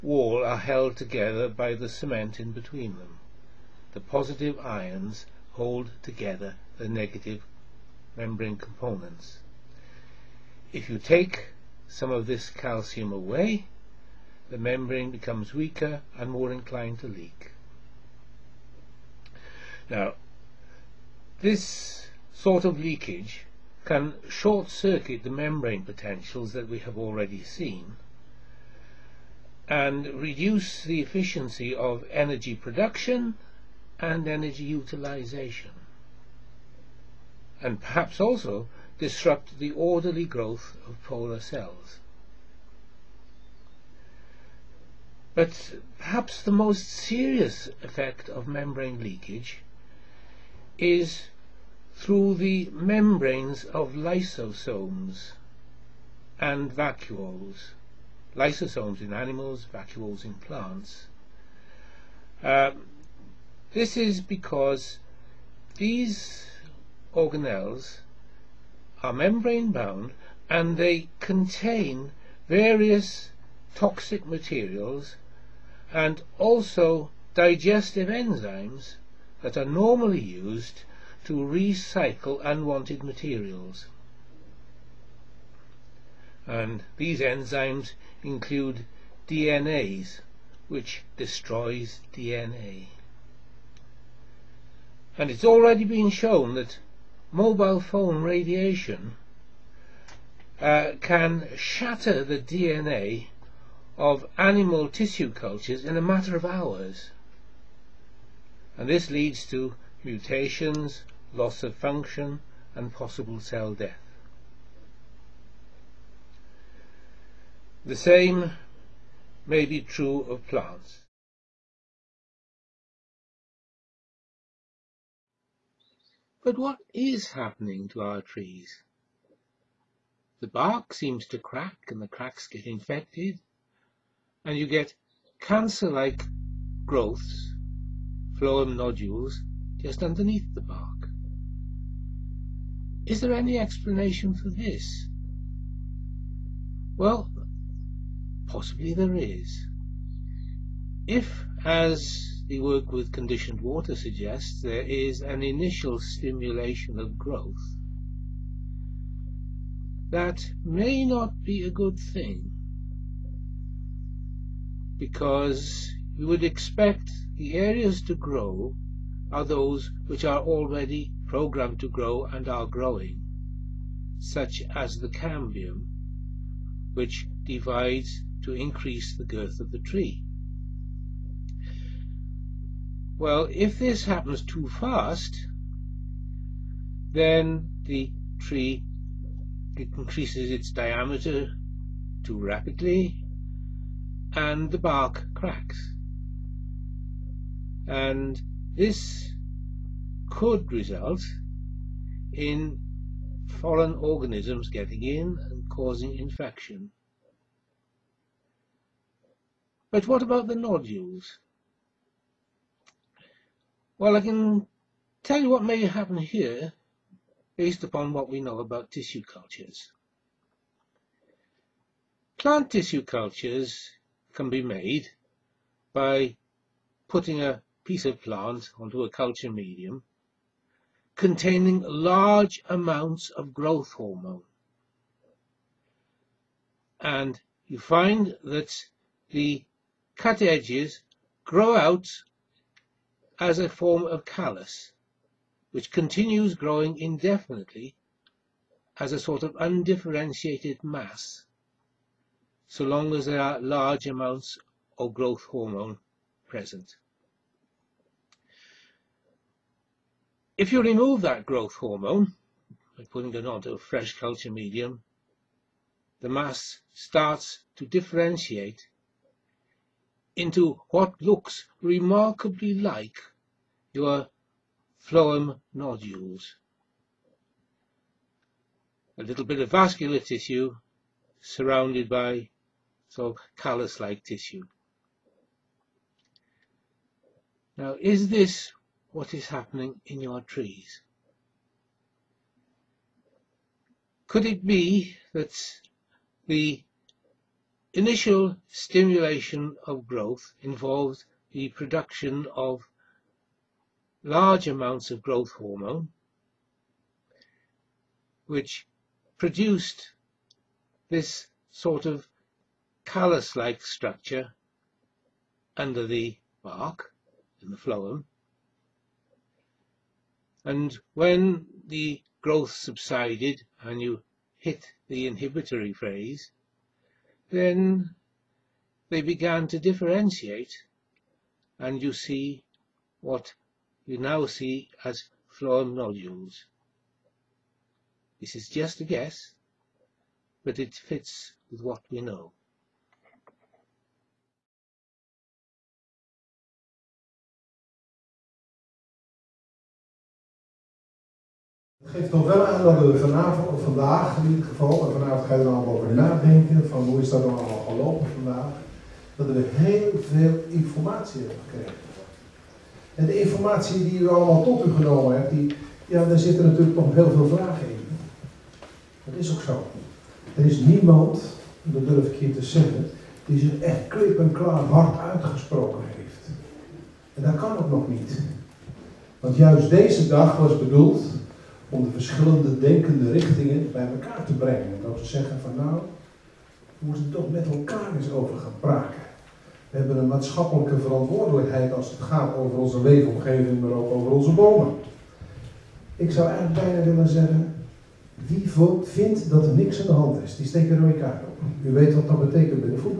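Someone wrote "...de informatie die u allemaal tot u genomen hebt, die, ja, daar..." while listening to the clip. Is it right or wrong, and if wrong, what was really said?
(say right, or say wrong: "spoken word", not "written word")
right.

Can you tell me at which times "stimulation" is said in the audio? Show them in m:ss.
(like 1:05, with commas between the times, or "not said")
2:35, 4:58.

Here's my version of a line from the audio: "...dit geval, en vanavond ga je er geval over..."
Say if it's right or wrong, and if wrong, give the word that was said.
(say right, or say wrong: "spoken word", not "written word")
wrong: "allemaal", not "geval".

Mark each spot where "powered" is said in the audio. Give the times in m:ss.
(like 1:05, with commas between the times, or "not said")
not said.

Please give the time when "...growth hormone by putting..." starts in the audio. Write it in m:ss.
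4:21.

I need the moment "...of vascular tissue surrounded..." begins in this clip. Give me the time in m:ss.
4:39.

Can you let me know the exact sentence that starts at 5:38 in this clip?
This is just a guess, but it fits with what we know.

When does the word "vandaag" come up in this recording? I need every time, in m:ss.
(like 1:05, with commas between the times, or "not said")
5:53, 5:58.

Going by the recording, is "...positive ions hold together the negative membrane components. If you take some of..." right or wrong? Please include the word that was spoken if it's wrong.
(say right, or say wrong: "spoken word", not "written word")
right.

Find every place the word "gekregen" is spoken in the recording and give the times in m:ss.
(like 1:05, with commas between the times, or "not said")
6:01.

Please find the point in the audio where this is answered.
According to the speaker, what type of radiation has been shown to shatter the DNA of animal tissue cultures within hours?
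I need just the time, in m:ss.
1:37.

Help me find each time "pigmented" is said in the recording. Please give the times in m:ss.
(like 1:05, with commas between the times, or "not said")
not said.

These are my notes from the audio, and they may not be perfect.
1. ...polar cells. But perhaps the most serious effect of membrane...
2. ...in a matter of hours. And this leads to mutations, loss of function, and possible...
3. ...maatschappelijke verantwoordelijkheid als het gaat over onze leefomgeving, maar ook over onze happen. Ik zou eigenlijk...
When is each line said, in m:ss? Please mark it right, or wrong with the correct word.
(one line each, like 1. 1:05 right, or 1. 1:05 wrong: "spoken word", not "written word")
1. 0:41 right
2. 1:45 right
3. 6:30 wrong: "bomen", not "happen".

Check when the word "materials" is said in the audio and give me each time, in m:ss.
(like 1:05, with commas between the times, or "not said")
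1:14, 1:23.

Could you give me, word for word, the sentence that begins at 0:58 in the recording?
Lysosomes in animals, vacuoles in plants.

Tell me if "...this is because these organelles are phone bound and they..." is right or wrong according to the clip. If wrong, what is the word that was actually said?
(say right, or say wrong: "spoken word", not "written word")
wrong: "membrane", not "phone".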